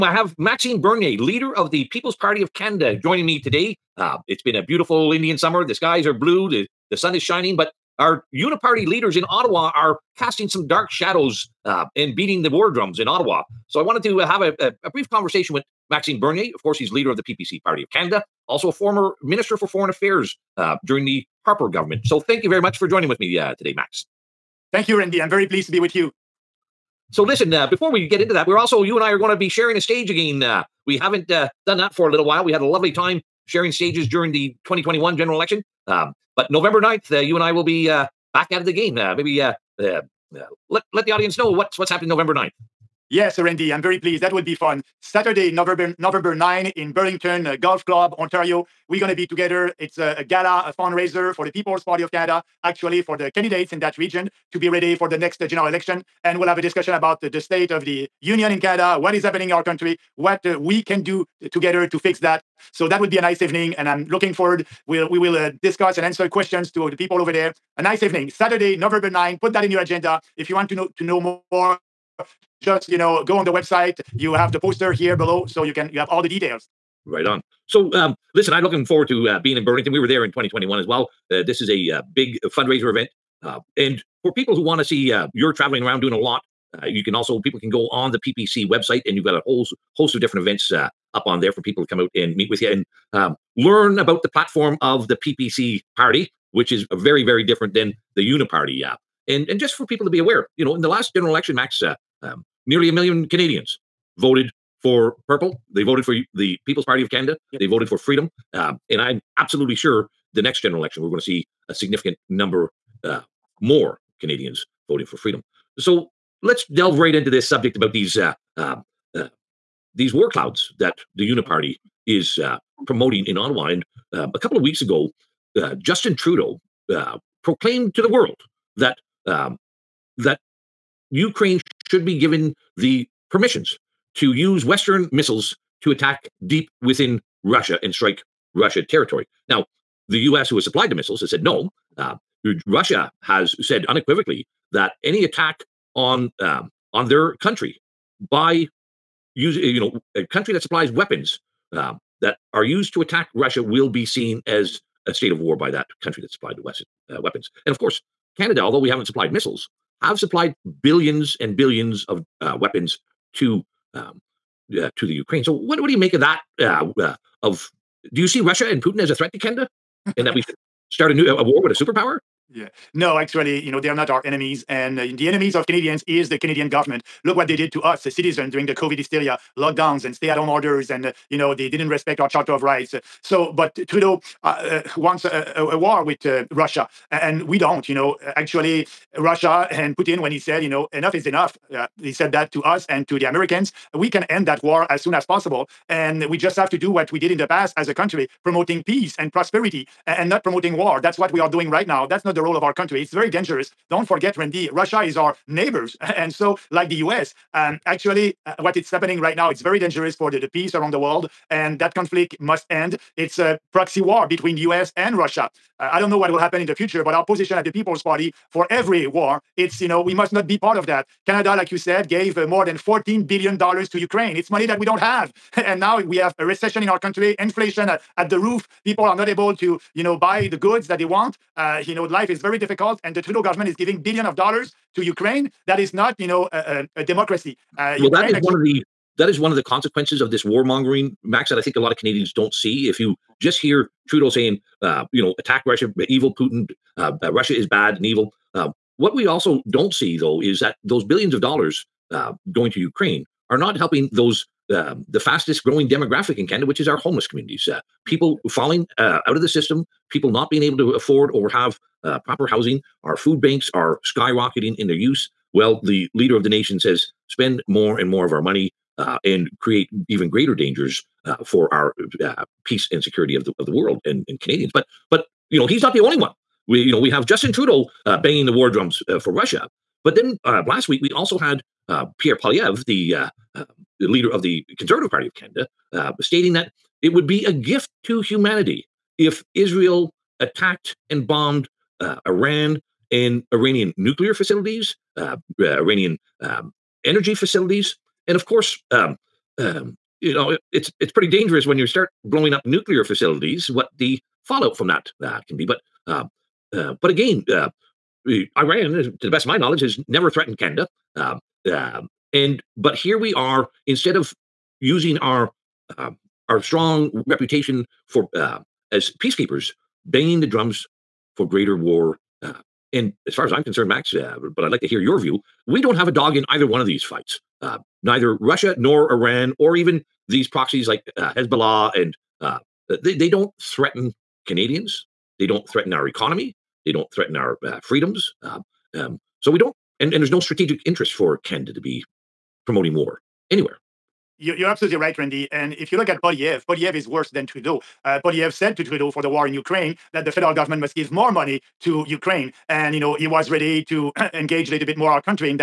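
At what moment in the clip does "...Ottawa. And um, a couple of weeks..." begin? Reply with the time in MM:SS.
02:03.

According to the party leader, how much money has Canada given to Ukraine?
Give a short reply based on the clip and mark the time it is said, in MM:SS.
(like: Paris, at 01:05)
more than $14 billion, at 03:42.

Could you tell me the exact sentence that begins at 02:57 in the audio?
Look what they did to us, the citizens, during the COVID hysteria, lockdowns and stay at home orders.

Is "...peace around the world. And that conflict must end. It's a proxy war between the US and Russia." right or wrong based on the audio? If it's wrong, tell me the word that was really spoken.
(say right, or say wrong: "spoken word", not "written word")
right.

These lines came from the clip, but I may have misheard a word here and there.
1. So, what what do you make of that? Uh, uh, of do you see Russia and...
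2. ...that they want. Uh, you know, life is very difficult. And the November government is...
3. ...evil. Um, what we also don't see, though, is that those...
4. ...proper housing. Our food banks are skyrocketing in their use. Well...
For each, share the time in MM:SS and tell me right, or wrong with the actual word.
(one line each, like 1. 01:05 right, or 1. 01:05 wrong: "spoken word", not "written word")
1. 02:45 right
2. 03:50 wrong: "Trudeau", not "November"
3. 04:08 right
4. 04:22 right.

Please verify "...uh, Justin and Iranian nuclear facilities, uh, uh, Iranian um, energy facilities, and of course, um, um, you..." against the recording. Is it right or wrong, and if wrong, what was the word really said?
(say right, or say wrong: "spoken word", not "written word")
wrong: "Iran", not "Justin".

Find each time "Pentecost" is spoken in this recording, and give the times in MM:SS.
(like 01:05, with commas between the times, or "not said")
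not said.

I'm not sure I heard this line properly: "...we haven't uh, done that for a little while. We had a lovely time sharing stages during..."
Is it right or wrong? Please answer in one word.
right.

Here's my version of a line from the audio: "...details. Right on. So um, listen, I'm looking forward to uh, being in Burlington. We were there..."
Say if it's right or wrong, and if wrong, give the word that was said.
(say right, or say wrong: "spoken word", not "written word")
right.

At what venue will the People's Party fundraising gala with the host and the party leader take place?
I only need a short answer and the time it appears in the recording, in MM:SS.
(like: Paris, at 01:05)
Burlington Golf Club, at 00:46.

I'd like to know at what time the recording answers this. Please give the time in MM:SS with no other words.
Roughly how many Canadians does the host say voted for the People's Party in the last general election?
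01:42.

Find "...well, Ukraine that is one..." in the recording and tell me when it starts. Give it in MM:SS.
03:57.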